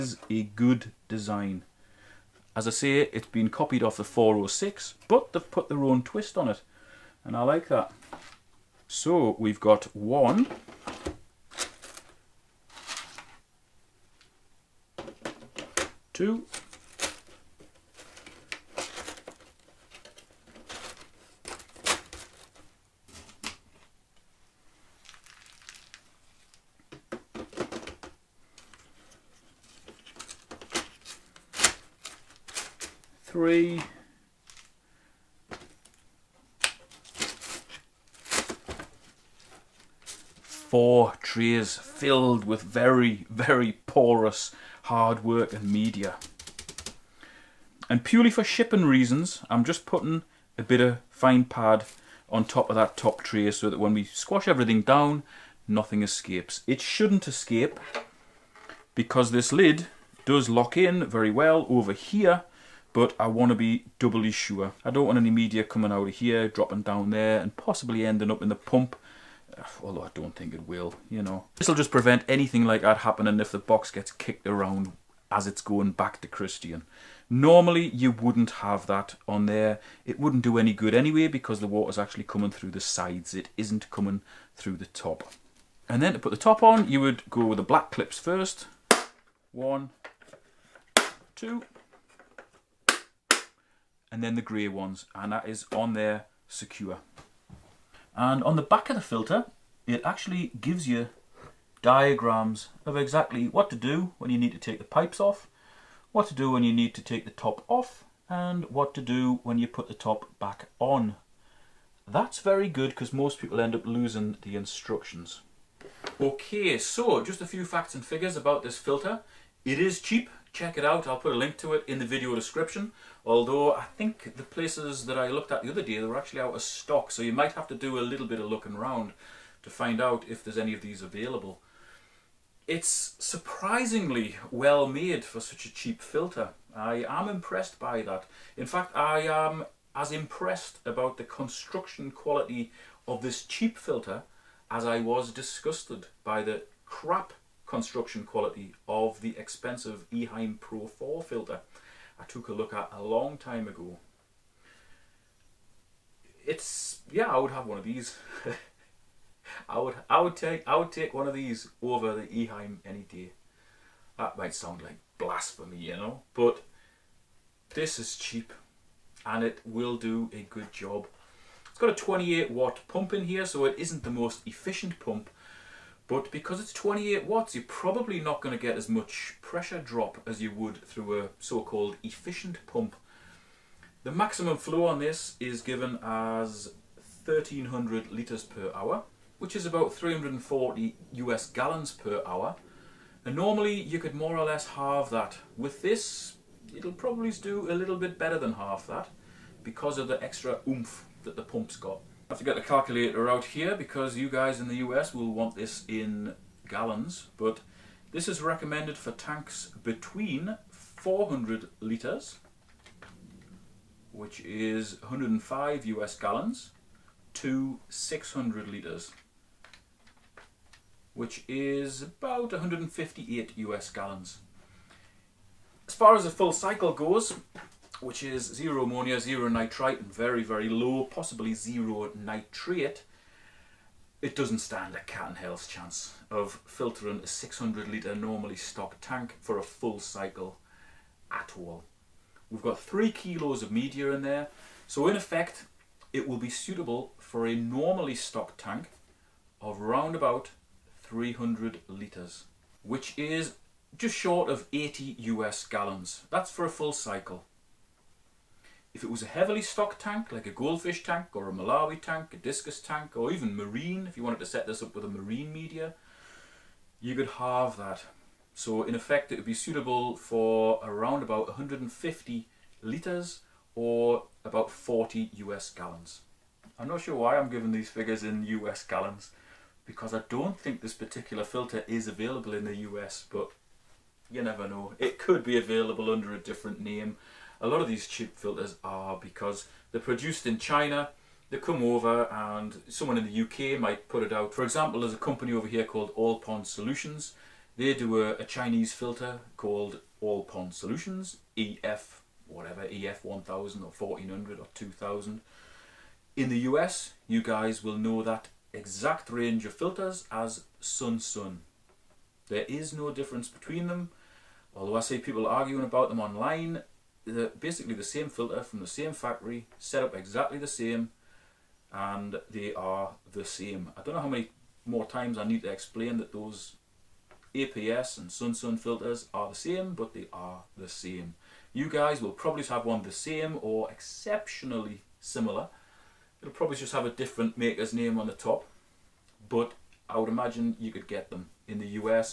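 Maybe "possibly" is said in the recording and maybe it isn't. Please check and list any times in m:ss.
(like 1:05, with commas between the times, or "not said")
1:07, 3:51.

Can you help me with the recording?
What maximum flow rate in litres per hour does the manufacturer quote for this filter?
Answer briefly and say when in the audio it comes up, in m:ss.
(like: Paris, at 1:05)
1300 litres per hour, at 3:07.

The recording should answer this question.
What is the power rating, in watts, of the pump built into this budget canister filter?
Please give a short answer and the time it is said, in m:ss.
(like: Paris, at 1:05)
28 watts, at 2:51.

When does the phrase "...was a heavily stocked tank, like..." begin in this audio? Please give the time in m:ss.
4:19.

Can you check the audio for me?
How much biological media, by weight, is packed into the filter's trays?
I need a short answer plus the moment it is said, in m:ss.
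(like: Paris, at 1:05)
3 kilos, at 4:02.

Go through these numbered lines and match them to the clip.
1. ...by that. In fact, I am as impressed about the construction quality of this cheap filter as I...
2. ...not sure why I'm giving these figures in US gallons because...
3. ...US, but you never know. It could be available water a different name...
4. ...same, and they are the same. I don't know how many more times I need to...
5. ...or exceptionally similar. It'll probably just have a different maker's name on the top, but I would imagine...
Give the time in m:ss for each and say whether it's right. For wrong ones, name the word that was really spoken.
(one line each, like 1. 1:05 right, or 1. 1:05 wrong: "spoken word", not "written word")
1. 2:17 right
2. 4:36 right
3. 4:42 wrong: "under", not "water"
4. 5:20 right
5. 5:33 right.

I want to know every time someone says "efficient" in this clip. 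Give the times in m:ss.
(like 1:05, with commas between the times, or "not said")
2:54, 3:02.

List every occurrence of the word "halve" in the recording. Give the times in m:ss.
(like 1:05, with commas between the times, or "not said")
3:14, 4:27.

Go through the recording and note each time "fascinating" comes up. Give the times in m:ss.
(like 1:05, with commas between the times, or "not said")
not said.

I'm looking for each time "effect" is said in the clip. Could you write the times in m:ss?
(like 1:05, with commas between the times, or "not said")
4:05, 4:28.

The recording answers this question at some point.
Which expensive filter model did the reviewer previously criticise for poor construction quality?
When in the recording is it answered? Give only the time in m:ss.
2:30.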